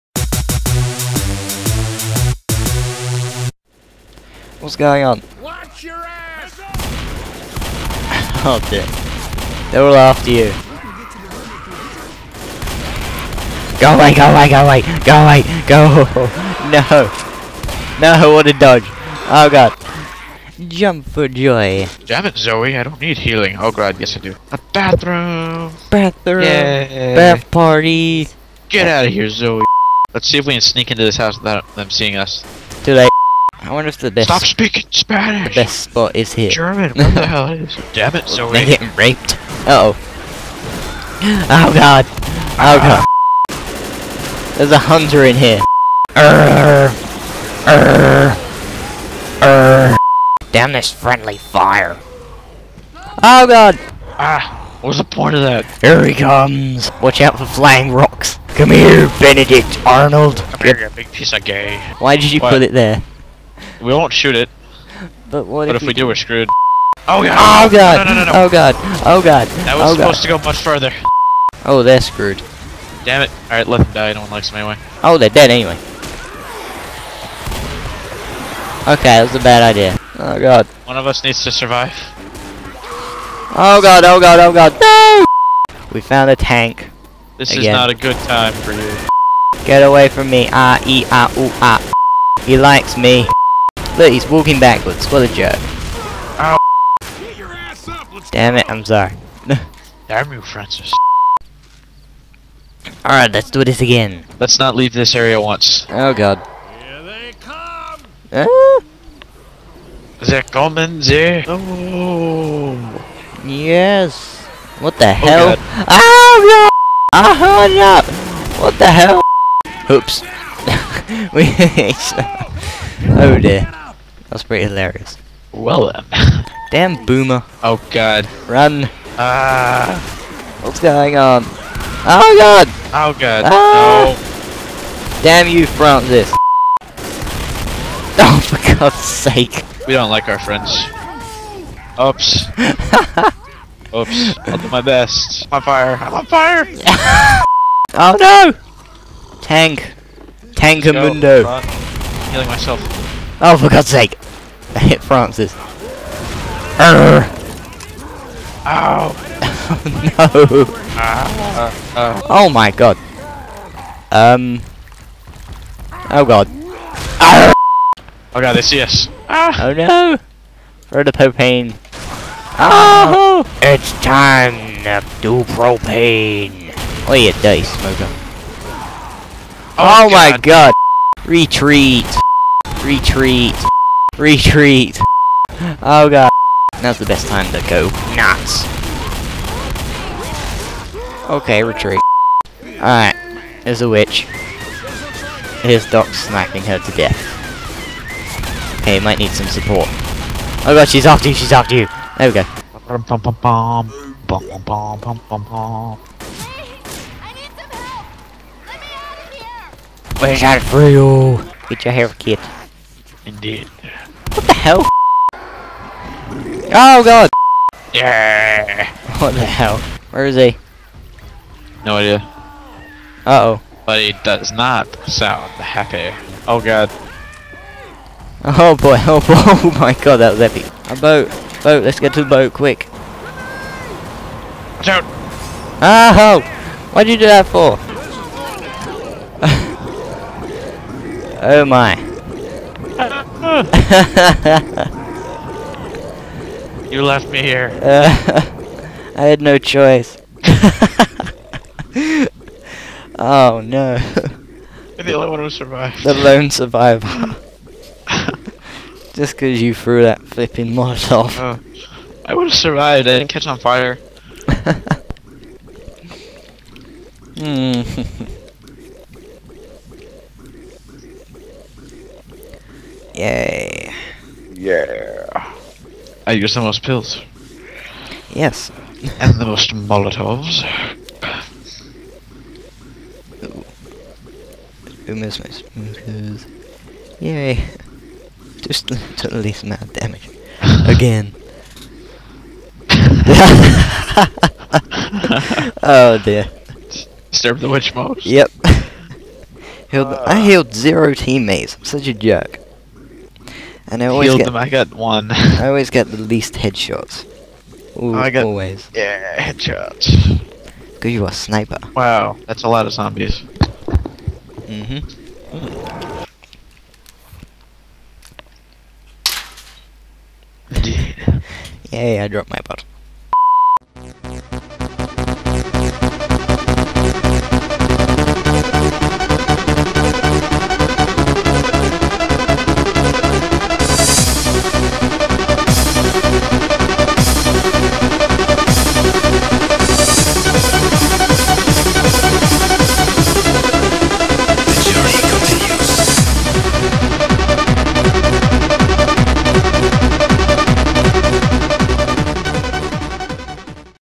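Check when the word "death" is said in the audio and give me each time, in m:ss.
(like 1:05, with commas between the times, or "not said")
3:16.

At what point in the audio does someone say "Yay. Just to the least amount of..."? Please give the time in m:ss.
4:47.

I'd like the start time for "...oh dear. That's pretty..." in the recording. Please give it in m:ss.
2:03.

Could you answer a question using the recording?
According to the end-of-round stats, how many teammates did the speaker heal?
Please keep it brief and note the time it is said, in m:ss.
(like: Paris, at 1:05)
0, at 5:00.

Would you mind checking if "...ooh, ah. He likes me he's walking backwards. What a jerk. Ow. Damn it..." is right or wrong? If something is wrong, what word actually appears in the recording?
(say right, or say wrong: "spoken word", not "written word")
right.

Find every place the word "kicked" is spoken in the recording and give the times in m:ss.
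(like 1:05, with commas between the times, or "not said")
not said.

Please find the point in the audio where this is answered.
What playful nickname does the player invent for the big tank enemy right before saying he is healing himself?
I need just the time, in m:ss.
2:30.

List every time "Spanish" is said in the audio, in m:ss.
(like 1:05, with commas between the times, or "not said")
0:34.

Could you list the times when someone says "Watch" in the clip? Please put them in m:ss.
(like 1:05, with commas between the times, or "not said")
0:05, 0:56, 3:54.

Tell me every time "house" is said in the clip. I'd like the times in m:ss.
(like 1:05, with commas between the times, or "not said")
0:31.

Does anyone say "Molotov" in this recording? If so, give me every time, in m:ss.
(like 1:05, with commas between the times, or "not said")
4:20, 4:39.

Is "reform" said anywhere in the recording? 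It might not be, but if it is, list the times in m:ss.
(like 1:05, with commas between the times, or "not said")
not said.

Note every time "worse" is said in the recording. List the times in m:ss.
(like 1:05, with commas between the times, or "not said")
not said.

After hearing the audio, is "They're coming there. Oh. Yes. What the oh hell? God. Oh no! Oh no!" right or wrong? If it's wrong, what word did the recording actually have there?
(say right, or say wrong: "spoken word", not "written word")
right.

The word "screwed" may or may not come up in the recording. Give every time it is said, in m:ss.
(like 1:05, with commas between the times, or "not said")
1:06, 1:12.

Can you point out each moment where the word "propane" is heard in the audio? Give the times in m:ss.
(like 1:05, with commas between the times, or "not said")
2:51, 2:55.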